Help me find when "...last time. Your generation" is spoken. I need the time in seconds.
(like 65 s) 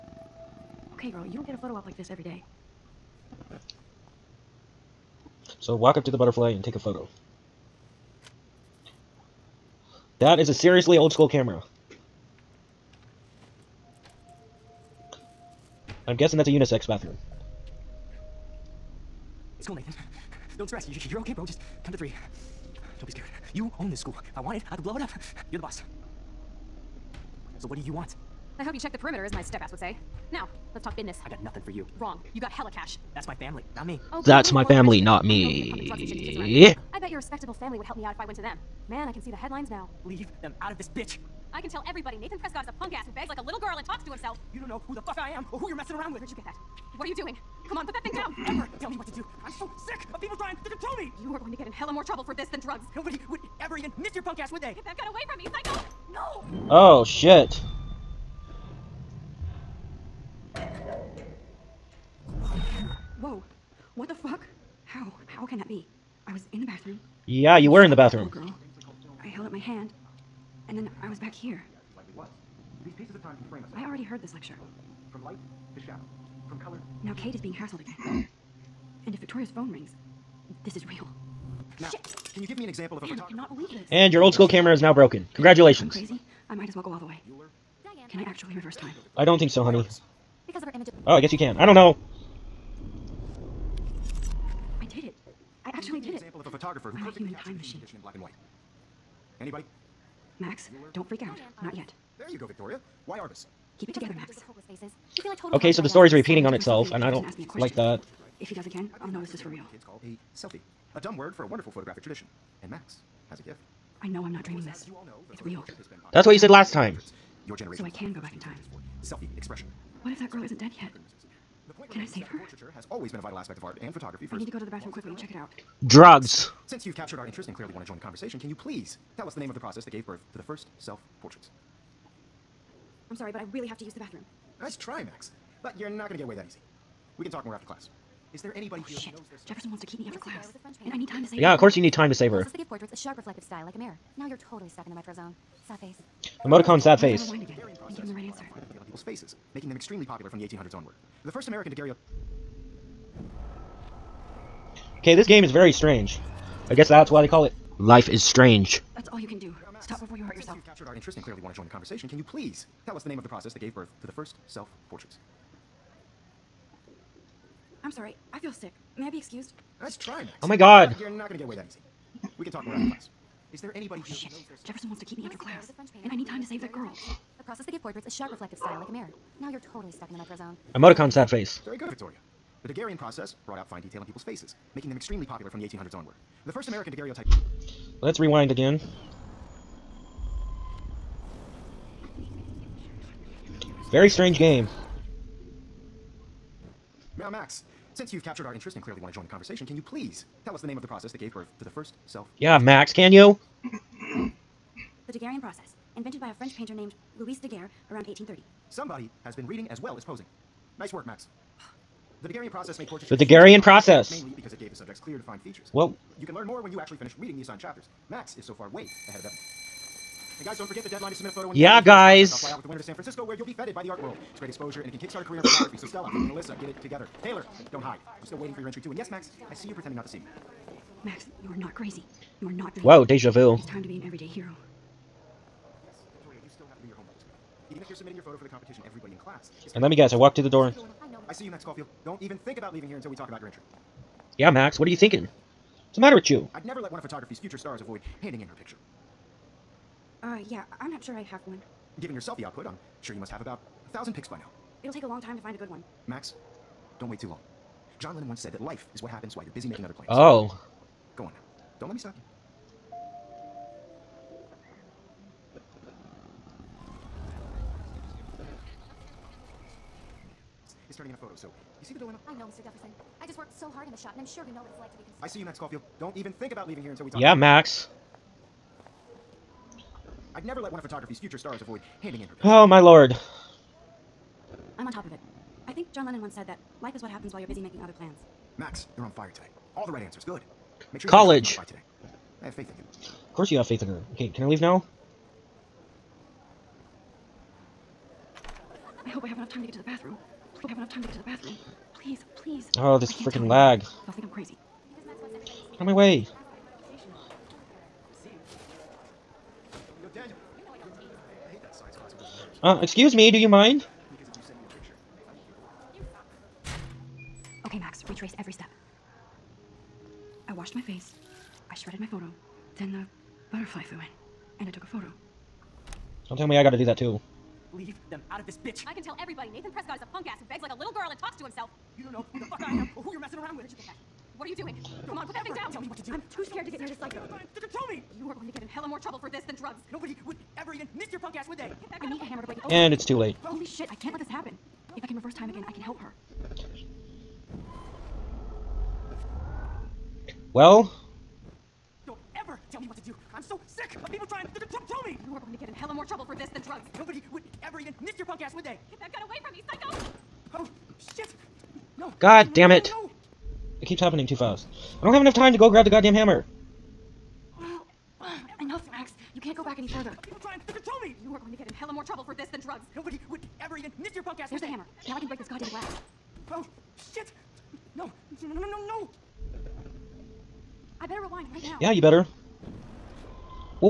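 116 s.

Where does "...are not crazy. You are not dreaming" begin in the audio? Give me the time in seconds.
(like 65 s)
231 s.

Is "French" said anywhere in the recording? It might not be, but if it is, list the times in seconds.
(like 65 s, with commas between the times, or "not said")
206 s.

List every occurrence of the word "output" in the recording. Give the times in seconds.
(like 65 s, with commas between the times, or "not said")
252 s.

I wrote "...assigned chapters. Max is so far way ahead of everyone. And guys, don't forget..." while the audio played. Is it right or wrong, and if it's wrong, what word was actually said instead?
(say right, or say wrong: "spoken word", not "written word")
right.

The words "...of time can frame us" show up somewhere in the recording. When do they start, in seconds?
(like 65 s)
73 s.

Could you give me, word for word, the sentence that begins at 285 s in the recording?
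I think John Lennon once said that Life is what happens while you're busy making other plans.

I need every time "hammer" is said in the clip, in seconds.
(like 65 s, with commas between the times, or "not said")
342 s, 366 s, 374 s.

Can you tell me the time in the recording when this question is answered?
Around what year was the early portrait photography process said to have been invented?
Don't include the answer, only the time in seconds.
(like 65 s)
208 s.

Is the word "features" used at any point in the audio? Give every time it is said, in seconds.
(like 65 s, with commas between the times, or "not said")
215 s.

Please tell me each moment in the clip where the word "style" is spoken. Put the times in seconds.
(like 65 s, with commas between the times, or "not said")
143 s, 178 s.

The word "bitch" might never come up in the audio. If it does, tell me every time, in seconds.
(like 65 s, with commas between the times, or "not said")
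40 s, 328 s.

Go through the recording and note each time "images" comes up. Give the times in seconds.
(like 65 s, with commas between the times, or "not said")
90 s.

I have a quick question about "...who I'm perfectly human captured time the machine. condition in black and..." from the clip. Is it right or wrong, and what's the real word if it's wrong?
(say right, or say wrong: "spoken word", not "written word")
right.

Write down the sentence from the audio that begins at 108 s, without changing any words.
If he does again, I'll know this is for real.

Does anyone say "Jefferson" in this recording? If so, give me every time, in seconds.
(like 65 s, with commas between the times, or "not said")
139 s, 174 s, 272 s.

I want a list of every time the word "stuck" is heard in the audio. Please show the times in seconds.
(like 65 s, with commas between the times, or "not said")
144 s, 179 s.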